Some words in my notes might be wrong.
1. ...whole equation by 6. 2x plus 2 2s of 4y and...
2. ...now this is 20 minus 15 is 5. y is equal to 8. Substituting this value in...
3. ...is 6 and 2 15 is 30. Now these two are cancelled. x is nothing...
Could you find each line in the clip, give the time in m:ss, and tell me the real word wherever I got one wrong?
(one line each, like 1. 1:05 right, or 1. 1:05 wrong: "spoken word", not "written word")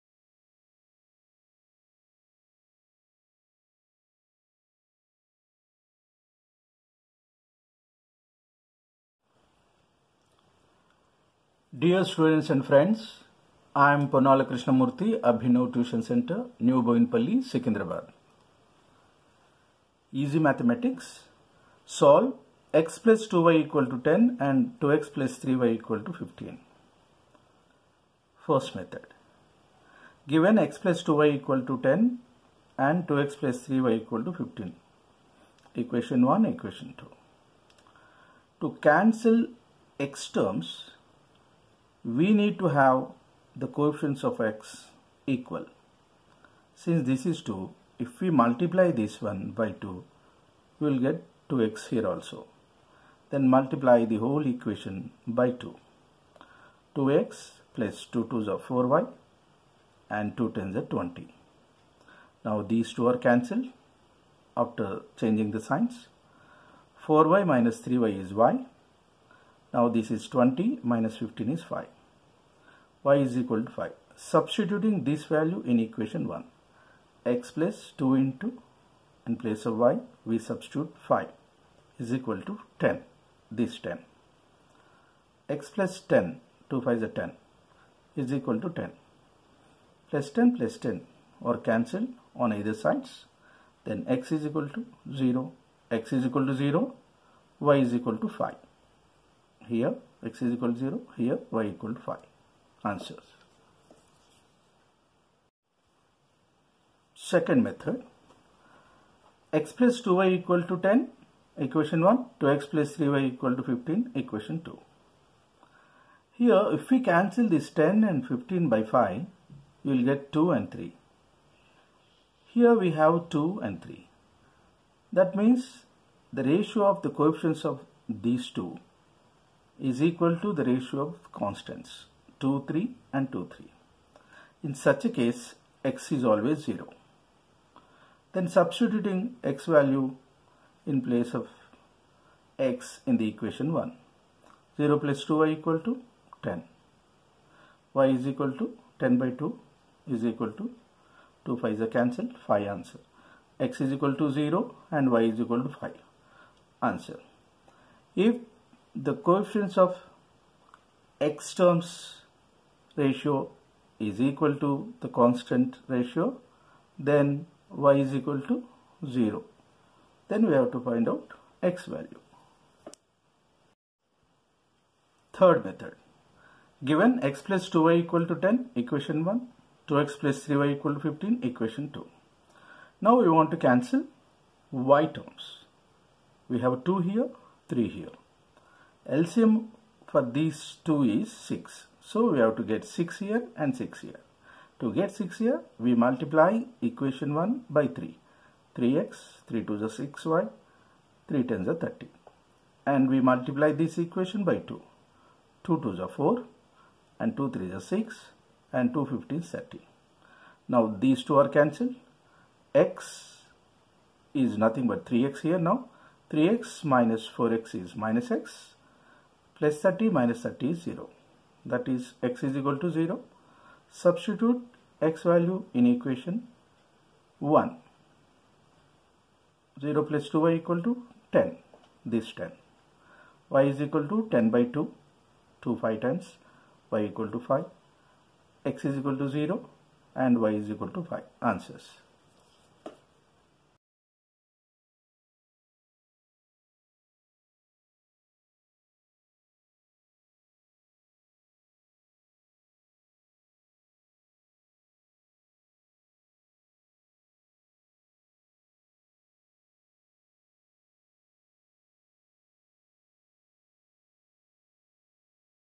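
1. 0:54 wrong: "2", not "6"
2. 1:09 wrong: "5", not "8"
3. 3:27 right.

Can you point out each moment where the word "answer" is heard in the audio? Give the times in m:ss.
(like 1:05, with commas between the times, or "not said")
1:42, 2:32, 2:36, 4:01.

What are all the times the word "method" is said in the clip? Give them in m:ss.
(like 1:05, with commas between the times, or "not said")
0:28, 1:47, 2:55.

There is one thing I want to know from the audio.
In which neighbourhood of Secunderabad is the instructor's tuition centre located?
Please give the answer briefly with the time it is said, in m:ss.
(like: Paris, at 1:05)
New Boinpalli, at 0:16.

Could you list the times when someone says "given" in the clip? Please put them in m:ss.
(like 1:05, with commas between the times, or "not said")
0:30, 2:56.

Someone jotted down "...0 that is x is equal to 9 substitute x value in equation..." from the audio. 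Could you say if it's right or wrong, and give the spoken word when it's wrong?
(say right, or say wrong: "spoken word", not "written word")
wrong: "0", not "9".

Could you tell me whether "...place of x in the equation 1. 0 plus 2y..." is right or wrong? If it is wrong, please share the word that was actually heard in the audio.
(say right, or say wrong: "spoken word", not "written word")
right.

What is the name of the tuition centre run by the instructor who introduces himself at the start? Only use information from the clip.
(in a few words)
Abhinav Tuition Center.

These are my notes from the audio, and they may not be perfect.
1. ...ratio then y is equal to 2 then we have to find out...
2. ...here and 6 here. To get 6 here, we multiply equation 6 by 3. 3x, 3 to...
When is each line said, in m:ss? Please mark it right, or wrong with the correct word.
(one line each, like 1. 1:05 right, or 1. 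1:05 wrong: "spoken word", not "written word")
1. 2:45 wrong: "0", not "2"
2. 3:13 wrong: "1", not "6".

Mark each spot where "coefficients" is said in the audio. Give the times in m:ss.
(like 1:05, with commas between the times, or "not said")
0:43, 2:07, 2:39.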